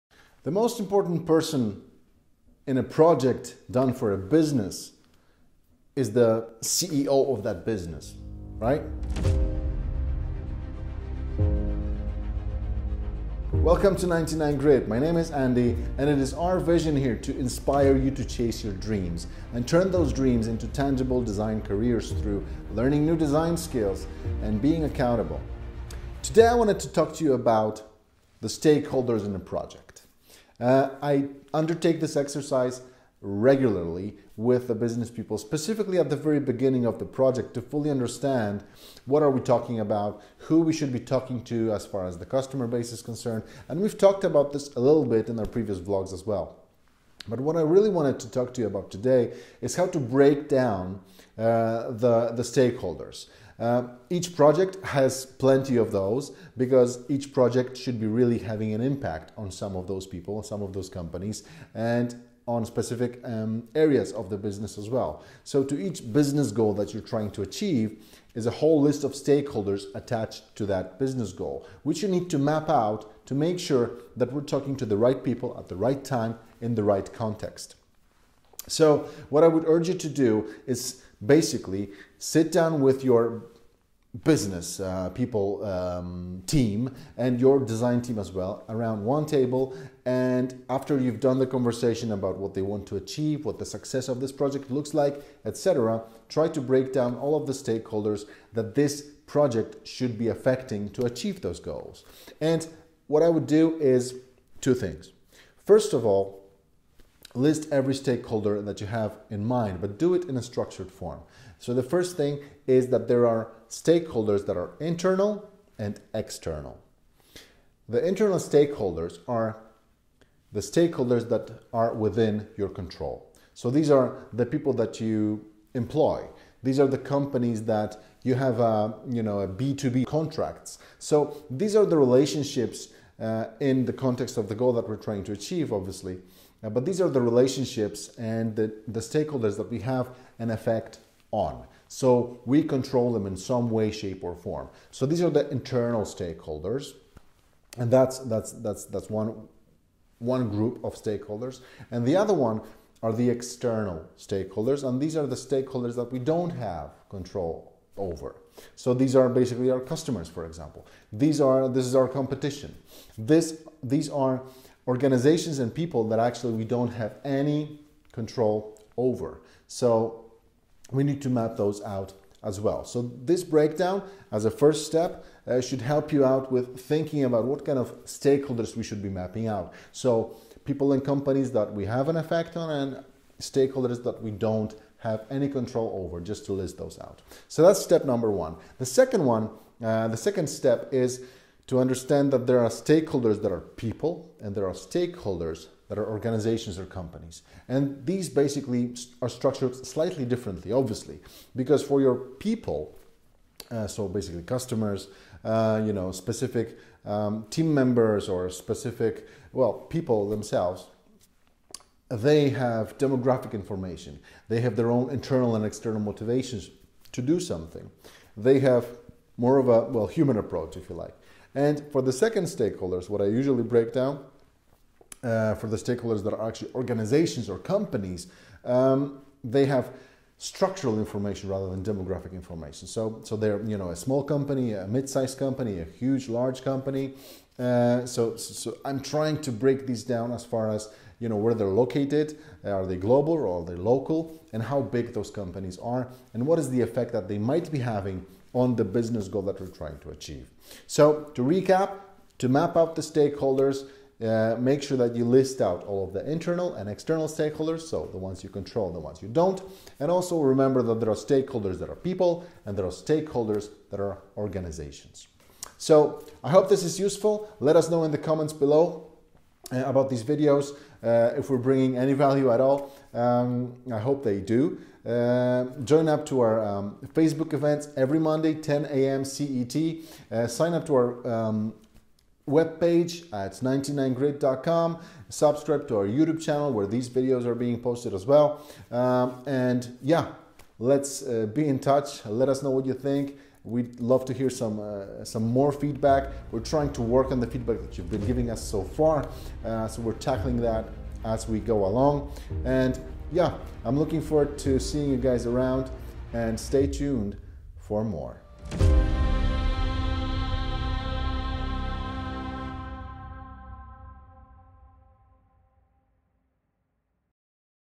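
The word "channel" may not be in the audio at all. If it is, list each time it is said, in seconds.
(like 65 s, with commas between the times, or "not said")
286 s.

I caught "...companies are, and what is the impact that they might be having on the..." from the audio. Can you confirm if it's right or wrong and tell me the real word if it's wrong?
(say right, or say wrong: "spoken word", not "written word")
wrong: "effect", not "impact".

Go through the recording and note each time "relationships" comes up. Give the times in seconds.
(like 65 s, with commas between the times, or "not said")
131 s, 137 s.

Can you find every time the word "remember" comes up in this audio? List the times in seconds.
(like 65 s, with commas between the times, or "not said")
260 s.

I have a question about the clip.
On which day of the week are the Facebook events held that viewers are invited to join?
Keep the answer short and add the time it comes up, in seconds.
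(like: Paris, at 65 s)
Monday, at 278 s.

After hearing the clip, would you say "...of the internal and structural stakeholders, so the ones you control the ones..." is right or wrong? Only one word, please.
wrong.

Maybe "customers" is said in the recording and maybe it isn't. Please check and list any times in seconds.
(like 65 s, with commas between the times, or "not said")
42 s, 159 s, 204 s.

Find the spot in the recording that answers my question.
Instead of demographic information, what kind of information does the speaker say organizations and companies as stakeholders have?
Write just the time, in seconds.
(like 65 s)
230 s.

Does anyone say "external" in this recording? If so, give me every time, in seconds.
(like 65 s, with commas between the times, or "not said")
116 s, 153 s, 215 s, 256 s.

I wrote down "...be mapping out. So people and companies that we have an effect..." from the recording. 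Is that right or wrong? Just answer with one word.
right.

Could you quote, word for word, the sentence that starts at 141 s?
So we control them in some way, shape, or form.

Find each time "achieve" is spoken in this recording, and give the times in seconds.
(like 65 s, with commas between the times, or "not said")
67 s, 92 s, 101 s, 135 s, 250 s.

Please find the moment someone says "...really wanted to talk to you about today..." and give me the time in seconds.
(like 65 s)
47 s.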